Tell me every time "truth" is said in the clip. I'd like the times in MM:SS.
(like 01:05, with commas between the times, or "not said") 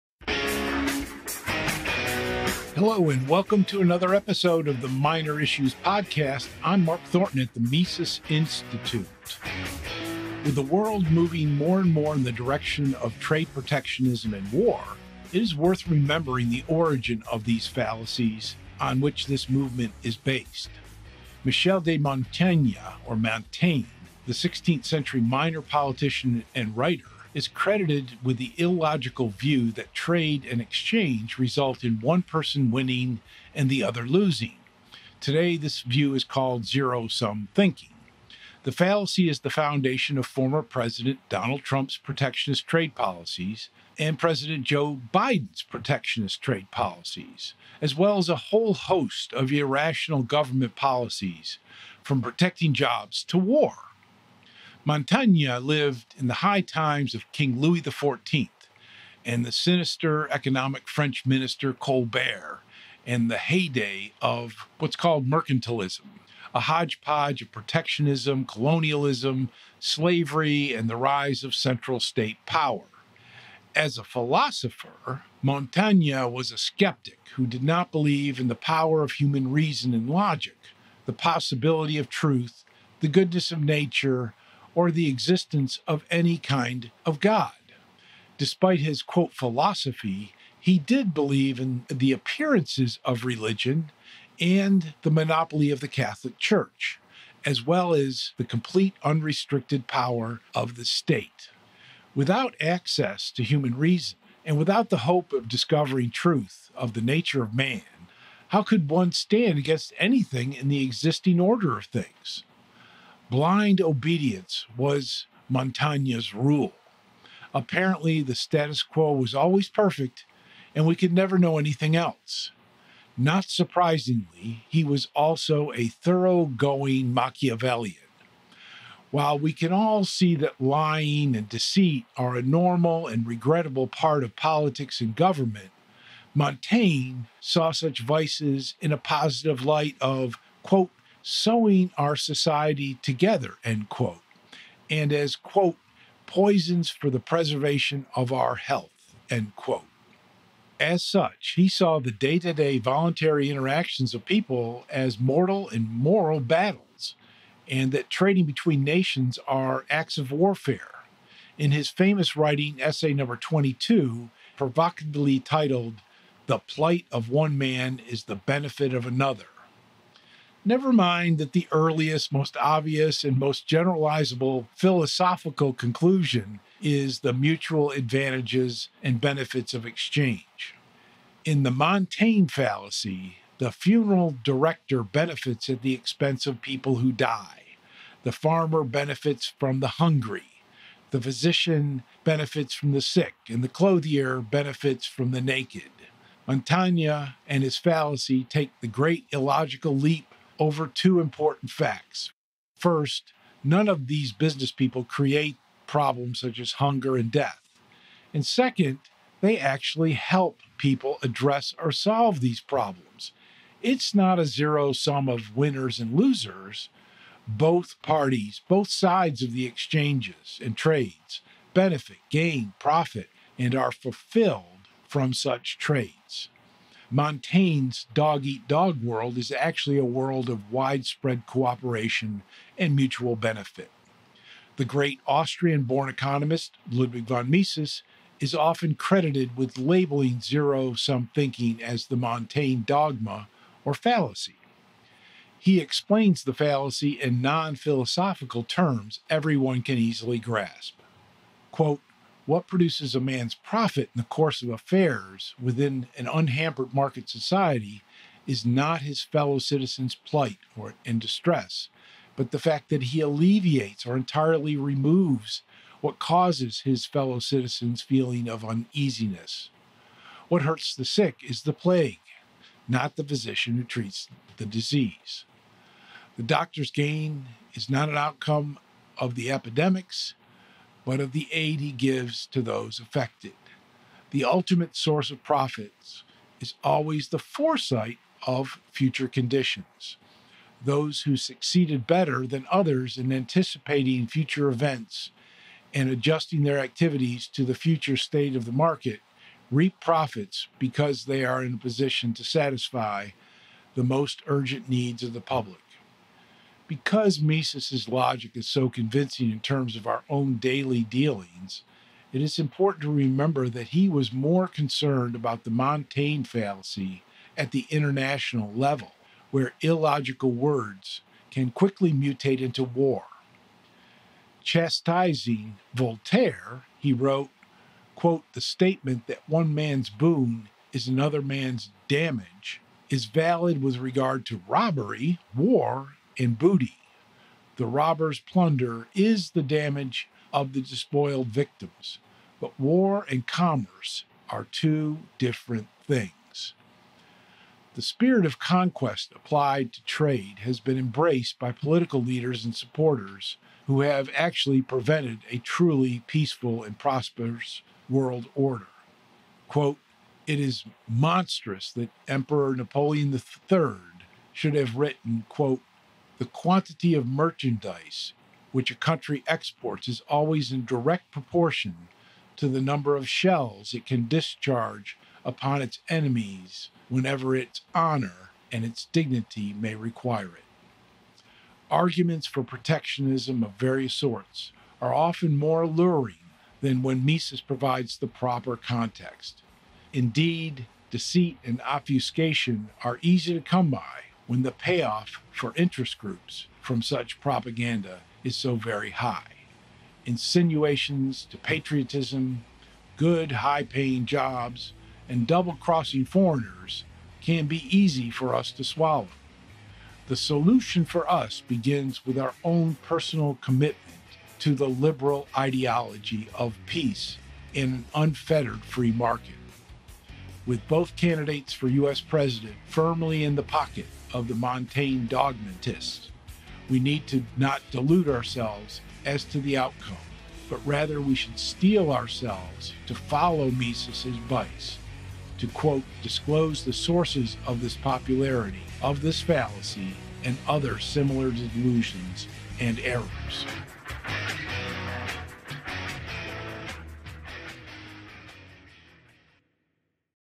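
01:22, 01:46.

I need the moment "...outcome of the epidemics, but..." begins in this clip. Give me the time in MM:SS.
04:38.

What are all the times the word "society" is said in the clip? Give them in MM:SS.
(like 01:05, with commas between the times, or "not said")
02:22, 04:17.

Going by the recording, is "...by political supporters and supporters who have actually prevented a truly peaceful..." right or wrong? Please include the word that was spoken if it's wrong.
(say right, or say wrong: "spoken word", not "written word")
wrong: "leaders", not "supporters".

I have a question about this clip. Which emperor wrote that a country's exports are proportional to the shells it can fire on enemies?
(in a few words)
Napoleon III.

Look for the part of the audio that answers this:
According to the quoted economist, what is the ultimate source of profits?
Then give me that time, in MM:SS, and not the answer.
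04:47.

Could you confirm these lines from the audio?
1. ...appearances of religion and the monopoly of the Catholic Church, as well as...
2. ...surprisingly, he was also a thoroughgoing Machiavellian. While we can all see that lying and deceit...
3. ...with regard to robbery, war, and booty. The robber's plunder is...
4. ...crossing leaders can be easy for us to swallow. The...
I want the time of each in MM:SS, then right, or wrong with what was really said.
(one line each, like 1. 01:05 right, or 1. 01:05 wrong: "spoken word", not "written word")
1. 01:32 right
2. 02:03 right
3. 05:33 right
4. 06:45 wrong: "foreigners", not "leaders".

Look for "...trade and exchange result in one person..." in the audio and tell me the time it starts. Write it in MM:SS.
00:29.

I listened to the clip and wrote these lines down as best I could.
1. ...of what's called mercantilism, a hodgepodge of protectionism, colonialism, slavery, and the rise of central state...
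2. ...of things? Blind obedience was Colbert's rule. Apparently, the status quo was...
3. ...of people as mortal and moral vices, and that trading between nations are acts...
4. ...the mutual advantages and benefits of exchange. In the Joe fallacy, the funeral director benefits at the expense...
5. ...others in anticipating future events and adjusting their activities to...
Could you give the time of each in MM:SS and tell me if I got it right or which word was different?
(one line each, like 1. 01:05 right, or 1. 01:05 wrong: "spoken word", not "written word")
1. 01:04 right
2. 01:51 wrong: "Montaigne", not "Colbert"
3. 02:34 wrong: "battles", not "vices"
4. 02:57 wrong: "Montaigne", not "Joe"
5. 04:52 right.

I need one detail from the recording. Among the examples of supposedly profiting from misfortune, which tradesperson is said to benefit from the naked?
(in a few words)
the clothier.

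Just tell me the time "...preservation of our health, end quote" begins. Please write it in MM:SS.
02:27.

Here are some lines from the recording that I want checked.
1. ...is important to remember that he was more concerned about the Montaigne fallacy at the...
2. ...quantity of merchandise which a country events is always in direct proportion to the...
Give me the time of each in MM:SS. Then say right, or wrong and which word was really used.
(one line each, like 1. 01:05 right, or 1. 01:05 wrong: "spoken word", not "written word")
1. 05:12 right
2. 06:06 wrong: "exports", not "events".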